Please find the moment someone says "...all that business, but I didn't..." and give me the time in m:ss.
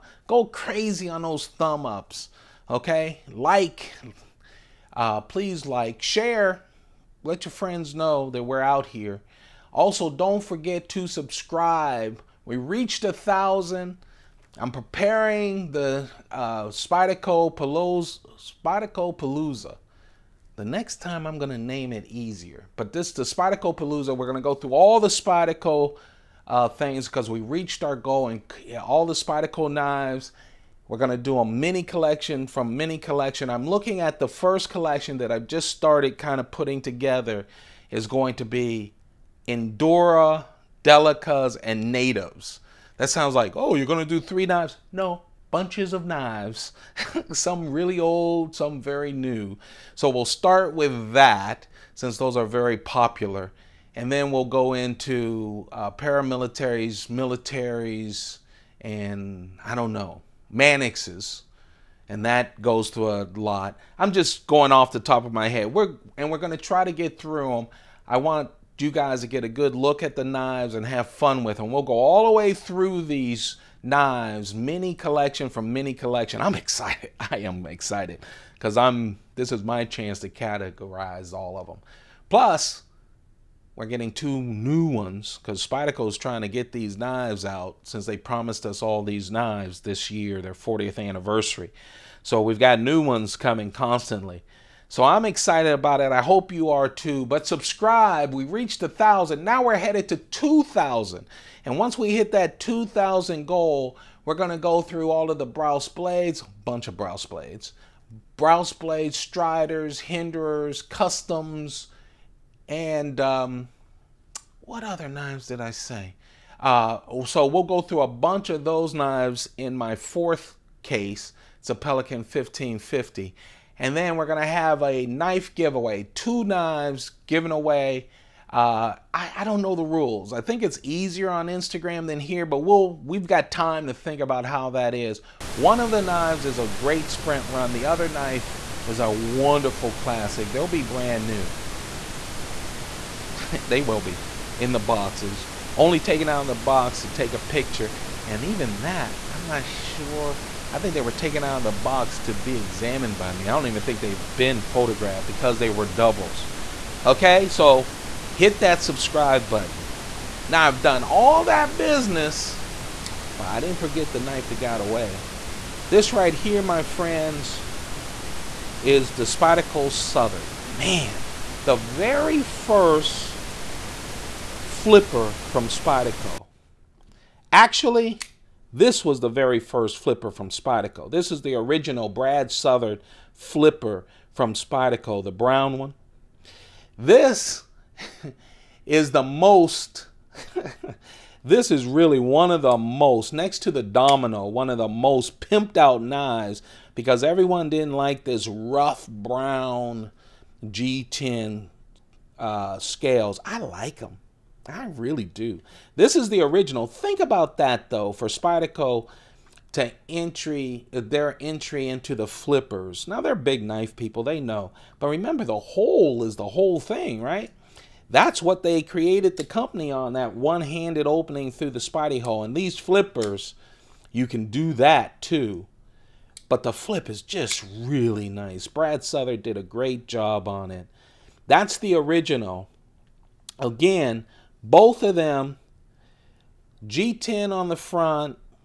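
2:41.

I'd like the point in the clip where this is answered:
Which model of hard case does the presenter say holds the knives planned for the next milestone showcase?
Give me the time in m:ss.
2:01.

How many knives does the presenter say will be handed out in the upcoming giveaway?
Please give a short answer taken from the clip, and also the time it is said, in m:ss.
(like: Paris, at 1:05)
2, at 2:06.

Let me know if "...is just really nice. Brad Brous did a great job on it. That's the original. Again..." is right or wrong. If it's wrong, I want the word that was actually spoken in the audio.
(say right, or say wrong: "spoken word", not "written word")
wrong: "Southard", not "Brous".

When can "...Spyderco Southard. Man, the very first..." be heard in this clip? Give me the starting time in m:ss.
2:49.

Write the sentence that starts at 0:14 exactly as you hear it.
I'm preparing the uh, Spyderco Palooza, Spyderco Palooza.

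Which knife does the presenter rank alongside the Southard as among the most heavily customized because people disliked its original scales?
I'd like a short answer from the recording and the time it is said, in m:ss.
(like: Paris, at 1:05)
Domino, at 3:13.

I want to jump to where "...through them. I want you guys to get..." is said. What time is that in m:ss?
1:07.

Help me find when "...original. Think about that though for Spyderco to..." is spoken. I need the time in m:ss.
3:26.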